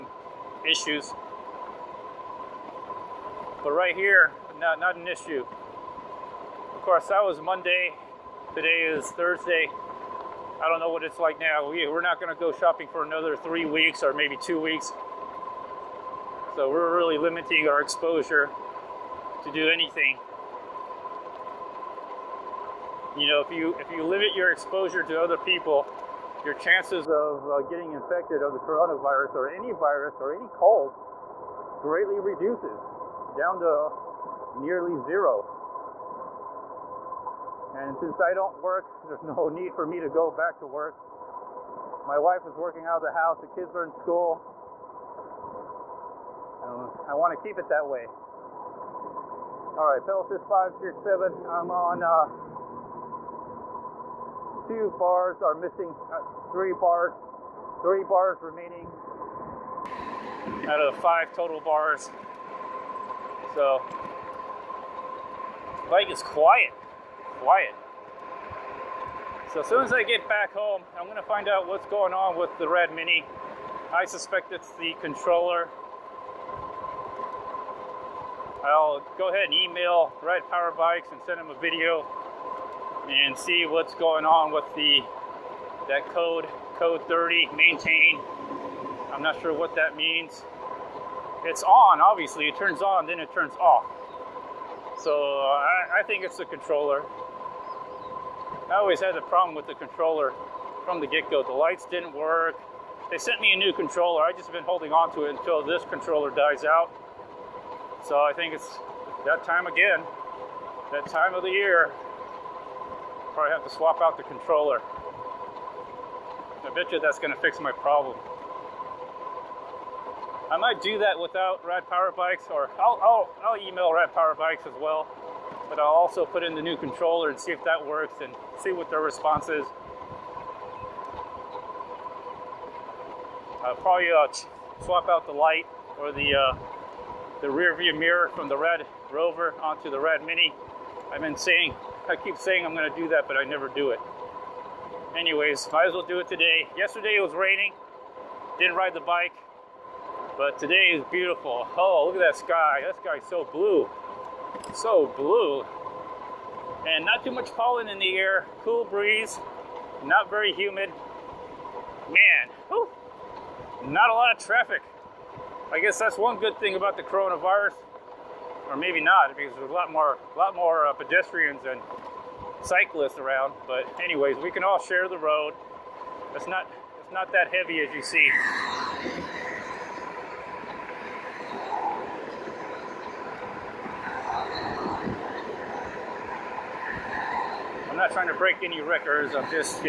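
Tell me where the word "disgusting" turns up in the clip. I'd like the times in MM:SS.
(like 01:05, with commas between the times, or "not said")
not said.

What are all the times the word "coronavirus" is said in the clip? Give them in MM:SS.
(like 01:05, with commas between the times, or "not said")
00:28, 02:47.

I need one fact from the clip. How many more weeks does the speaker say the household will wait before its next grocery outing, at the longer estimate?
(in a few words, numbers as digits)
3.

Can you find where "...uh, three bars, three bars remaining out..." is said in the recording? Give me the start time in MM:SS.
00:56.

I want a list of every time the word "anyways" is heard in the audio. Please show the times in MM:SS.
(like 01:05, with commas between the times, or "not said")
02:25, 02:54.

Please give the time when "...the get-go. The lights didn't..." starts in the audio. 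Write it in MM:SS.
01:40.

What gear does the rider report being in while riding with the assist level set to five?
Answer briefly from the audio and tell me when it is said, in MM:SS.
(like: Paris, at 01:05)
7, at 00:50.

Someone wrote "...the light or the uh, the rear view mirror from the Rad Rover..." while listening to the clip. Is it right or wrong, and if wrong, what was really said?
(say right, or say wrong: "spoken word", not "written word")
right.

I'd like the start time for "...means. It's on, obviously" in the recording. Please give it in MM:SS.
01:29.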